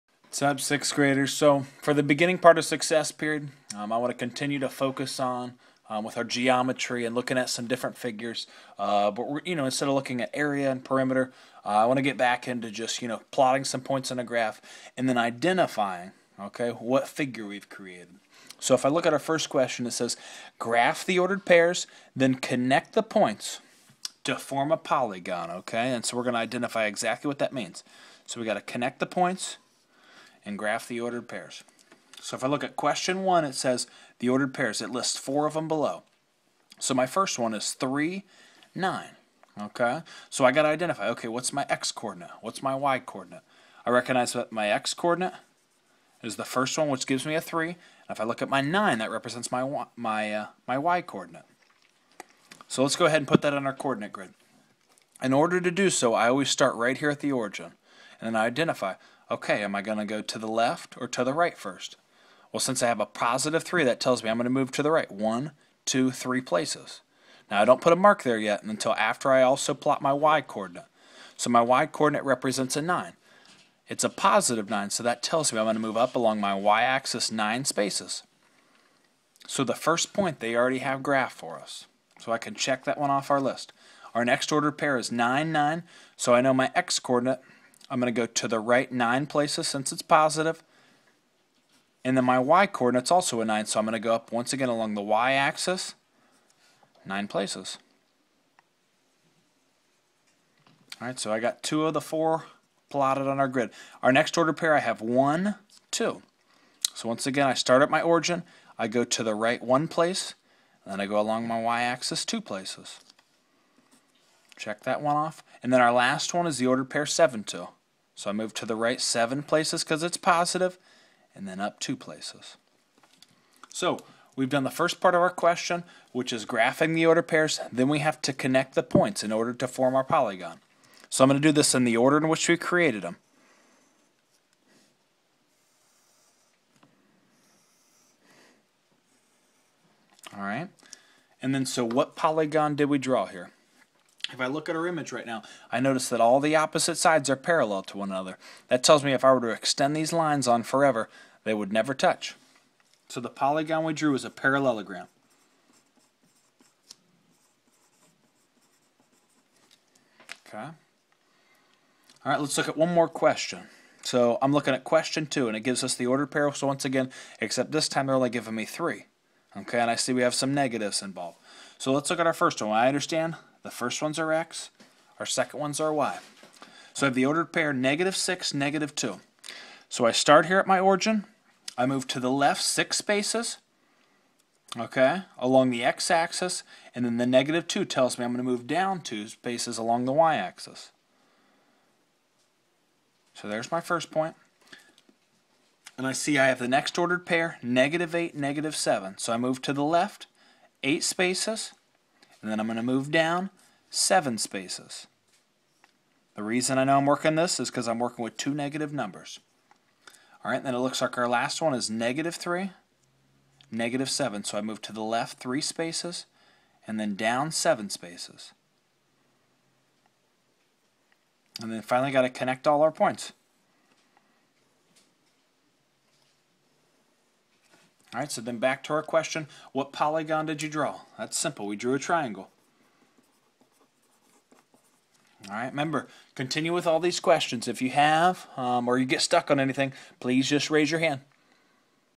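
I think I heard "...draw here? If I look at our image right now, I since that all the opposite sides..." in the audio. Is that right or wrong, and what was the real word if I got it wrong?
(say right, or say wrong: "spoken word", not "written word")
wrong: "notice", not "since".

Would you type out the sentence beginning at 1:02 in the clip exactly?
Well, since I have a positive 3, that tells me I'm going to move to the right one, two, three places.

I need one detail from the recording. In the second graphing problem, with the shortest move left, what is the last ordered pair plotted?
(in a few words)
(-3, -7).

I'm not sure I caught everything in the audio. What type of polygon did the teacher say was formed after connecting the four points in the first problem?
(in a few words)
parallelogram.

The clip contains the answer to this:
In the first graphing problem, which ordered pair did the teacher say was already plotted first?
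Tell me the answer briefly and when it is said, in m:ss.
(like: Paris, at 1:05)
(3, 9), at 0:37.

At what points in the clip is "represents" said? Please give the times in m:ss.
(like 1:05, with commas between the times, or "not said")
0:49, 1:12.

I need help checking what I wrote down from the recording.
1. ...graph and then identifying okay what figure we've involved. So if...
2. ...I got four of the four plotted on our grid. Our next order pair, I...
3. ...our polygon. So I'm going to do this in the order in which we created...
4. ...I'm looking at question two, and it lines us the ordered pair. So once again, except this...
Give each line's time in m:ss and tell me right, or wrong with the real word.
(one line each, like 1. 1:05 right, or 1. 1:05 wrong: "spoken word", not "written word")
1. 0:14 wrong: "created", not "involved"
2. 1:41 wrong: "two", not "four"
3. 2:09 right
4. 2:44 wrong: "gives", not "lines".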